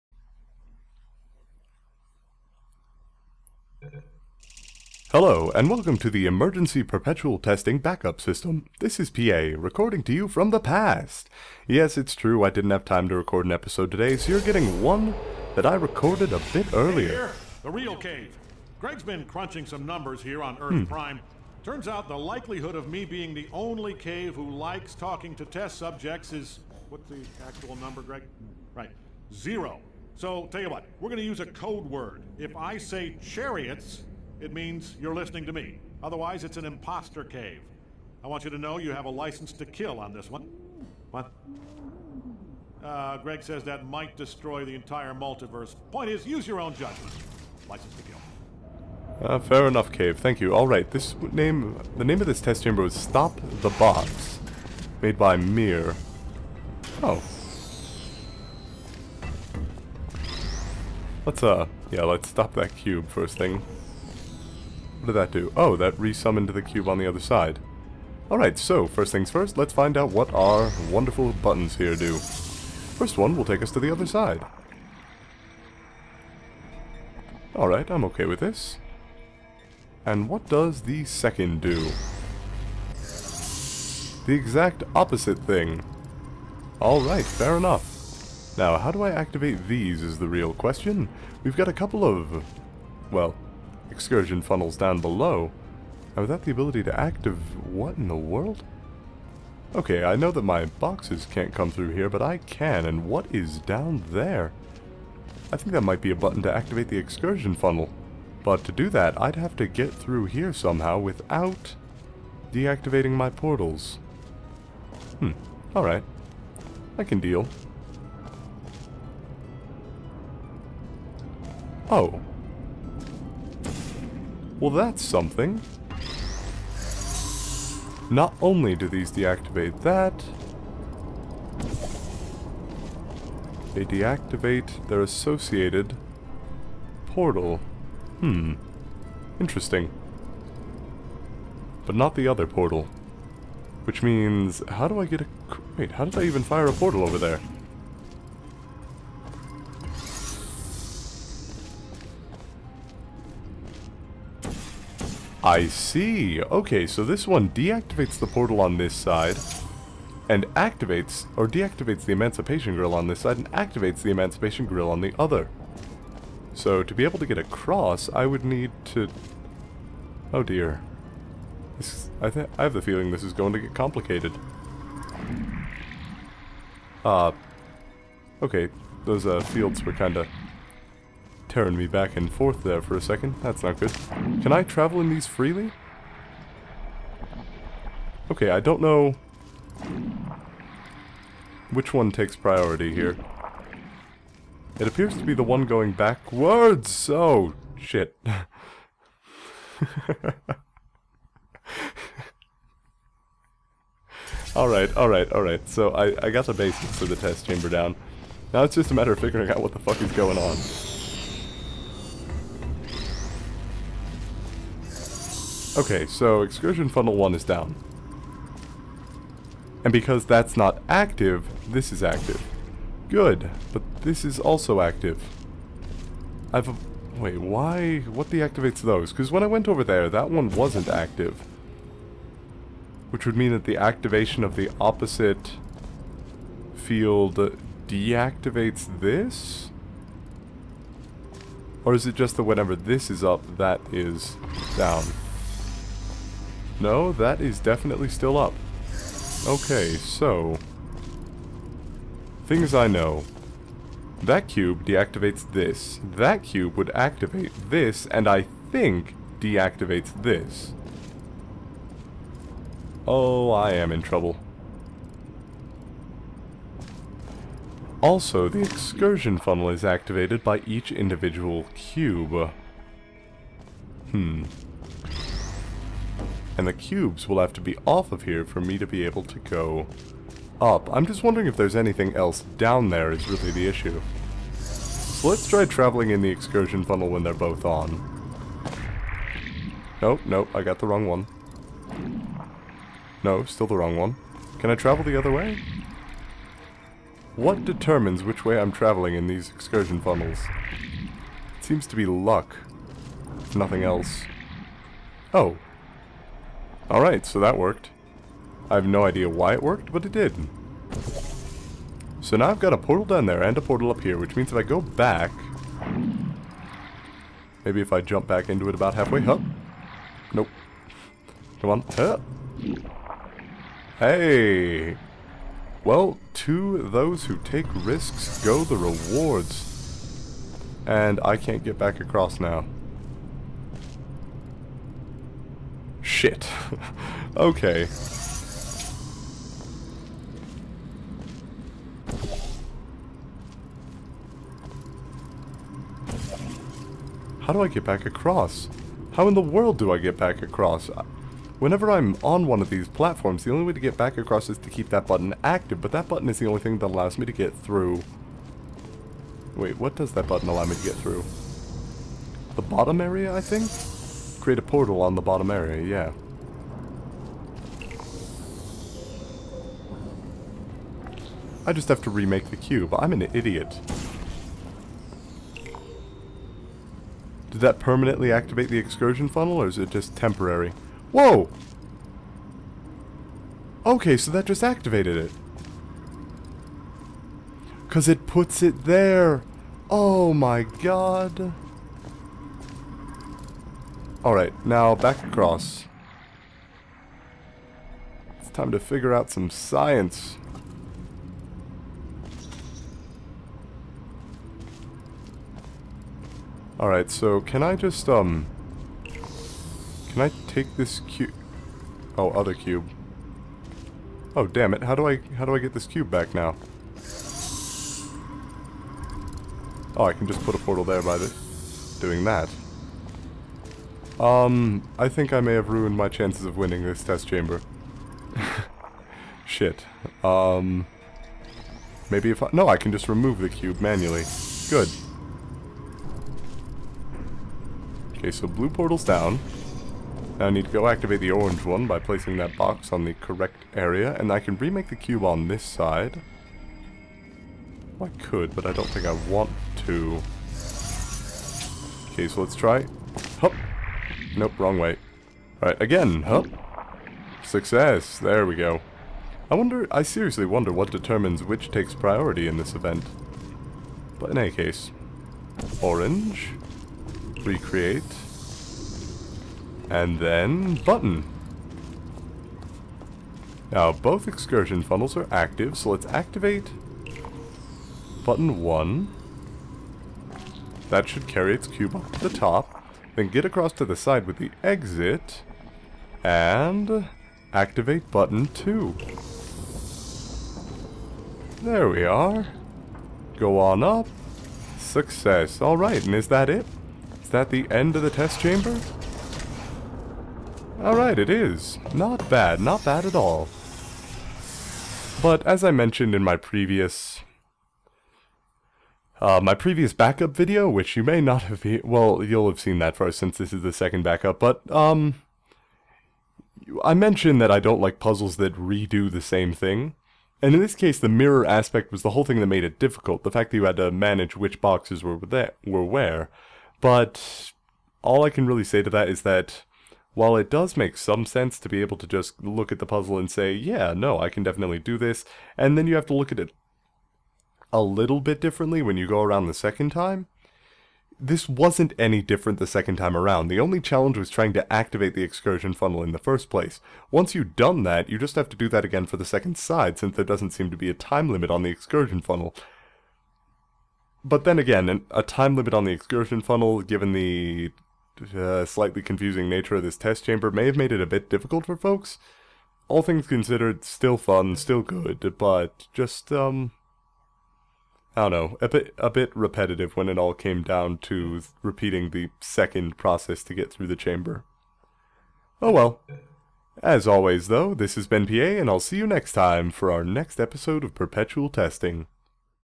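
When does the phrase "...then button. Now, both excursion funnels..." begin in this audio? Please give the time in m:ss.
7:50.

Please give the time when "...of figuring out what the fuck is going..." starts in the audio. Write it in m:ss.
3:29.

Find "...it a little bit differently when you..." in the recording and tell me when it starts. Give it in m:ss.
8:56.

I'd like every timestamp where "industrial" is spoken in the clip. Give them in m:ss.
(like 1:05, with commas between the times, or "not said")
not said.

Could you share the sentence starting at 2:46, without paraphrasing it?
So to be able to get across, I would need to...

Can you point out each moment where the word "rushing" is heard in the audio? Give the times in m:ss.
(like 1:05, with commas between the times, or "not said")
not said.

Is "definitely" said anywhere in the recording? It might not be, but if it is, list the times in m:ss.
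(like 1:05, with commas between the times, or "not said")
4:07, 8:54.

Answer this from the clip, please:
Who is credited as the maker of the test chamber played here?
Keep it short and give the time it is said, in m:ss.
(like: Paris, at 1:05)
Mir, at 0:55.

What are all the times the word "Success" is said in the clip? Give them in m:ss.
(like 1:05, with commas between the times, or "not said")
7:37, 8:14.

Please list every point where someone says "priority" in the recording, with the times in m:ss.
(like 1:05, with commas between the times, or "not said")
3:12, 7:41.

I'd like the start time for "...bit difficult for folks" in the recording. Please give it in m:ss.
9:21.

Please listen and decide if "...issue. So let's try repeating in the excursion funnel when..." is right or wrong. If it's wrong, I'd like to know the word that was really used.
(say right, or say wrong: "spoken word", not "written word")
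wrong: "traveling", not "repeating".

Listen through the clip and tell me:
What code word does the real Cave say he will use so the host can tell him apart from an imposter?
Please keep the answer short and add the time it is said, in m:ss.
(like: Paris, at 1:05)
chariots, at 0:33.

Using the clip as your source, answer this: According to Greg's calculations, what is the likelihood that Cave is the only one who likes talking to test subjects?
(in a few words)
zero.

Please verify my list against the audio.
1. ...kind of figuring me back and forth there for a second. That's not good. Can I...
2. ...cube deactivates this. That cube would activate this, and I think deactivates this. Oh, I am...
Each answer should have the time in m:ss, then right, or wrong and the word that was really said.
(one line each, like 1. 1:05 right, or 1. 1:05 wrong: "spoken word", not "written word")
1. 2:59 wrong: "tearing", not "figuring"
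2. 4:14 right.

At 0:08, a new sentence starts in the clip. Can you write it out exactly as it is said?
This is PA, recording to you from the past.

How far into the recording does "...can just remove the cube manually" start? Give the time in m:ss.
7:12.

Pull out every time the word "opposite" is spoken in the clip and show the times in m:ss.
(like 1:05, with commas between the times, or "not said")
1:24, 3:54.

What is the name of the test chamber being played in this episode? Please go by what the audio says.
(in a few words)
Stop the Box.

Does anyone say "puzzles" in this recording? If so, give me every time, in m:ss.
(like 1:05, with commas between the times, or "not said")
8:37, 8:52.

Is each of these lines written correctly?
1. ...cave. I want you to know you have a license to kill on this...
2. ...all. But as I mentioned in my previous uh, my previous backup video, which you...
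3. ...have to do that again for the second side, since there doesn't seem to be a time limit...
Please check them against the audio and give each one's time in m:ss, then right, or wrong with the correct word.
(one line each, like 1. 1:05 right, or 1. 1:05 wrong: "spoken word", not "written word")
1. 0:37 right
2. 8:23 right
3. 9:08 right.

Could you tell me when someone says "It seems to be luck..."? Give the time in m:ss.
5:01.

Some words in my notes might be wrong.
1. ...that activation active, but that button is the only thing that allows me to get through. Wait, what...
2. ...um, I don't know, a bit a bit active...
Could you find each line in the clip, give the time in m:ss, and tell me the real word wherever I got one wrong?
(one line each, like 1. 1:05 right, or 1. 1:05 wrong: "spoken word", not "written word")
1. 5:54 wrong: "button", not "activation"
2. 9:26 wrong: "repetitive", not "active".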